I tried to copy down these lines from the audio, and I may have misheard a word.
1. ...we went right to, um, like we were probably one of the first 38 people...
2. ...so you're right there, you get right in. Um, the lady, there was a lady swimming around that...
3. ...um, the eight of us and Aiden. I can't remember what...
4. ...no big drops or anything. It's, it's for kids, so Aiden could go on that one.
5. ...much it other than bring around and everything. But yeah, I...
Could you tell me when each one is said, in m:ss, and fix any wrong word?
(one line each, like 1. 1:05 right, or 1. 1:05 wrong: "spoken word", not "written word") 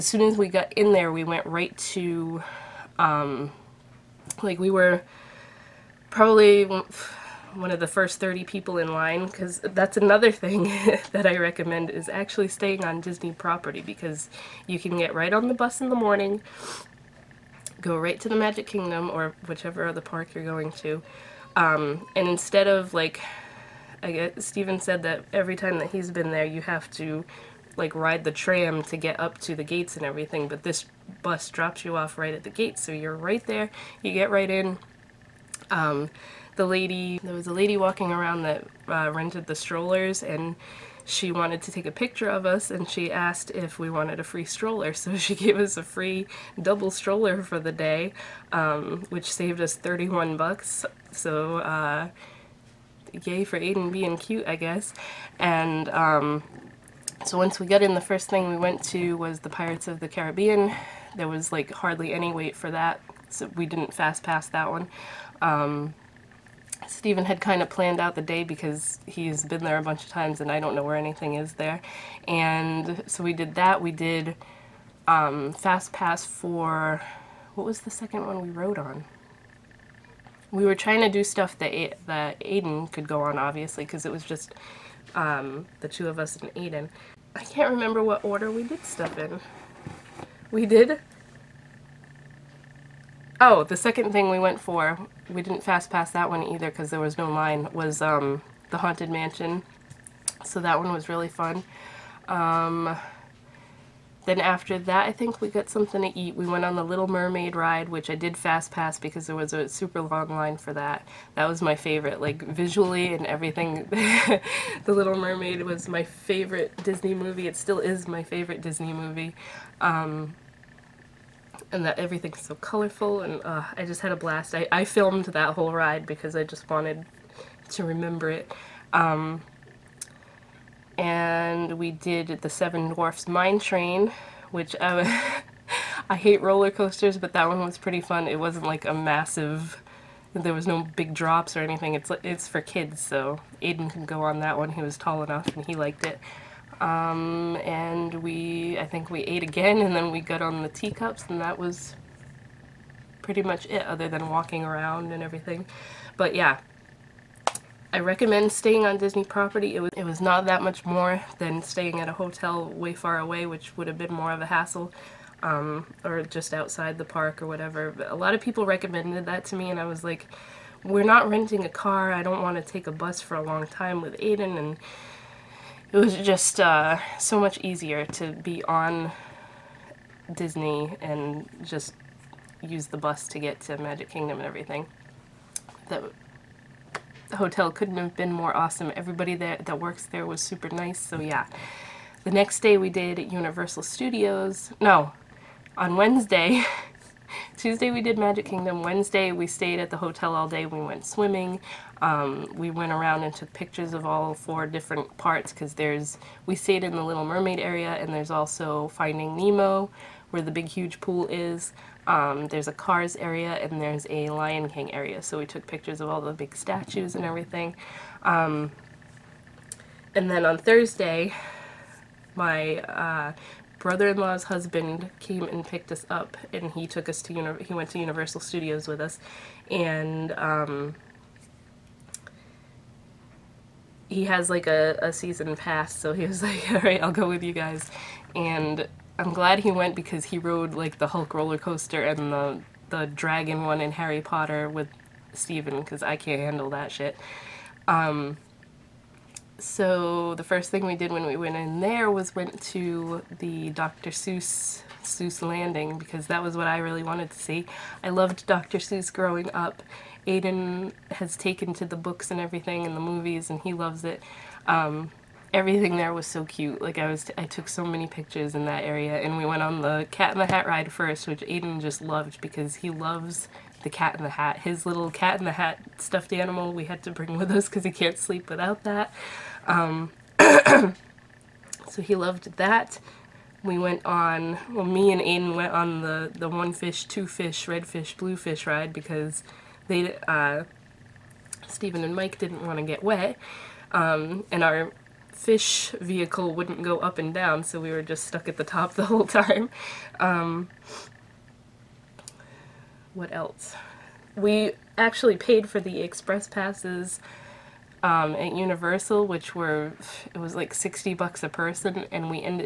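1. 0:01 wrong: "30", not "38"
2. 0:32 wrong: "walking", not "swimming"
3. 1:25 wrong: "two", not "eight"
4. 2:20 right
5. 2:33 wrong: "walking", not "bring".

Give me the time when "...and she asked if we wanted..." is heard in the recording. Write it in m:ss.
0:42.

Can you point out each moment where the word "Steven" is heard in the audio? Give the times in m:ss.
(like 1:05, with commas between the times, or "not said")
0:24, 4:05.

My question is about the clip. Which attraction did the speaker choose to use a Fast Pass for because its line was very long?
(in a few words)
Little Mermaid ride.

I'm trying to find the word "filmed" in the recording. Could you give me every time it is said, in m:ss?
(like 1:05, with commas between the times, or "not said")
2:04.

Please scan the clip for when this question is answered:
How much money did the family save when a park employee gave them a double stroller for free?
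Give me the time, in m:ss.
0:49.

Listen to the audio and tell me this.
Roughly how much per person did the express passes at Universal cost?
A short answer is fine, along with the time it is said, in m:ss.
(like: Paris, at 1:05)
$60, at 5:10.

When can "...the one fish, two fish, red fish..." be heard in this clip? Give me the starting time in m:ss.
4:46.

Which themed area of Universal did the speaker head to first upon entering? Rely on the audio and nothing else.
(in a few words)
Seuss Landing.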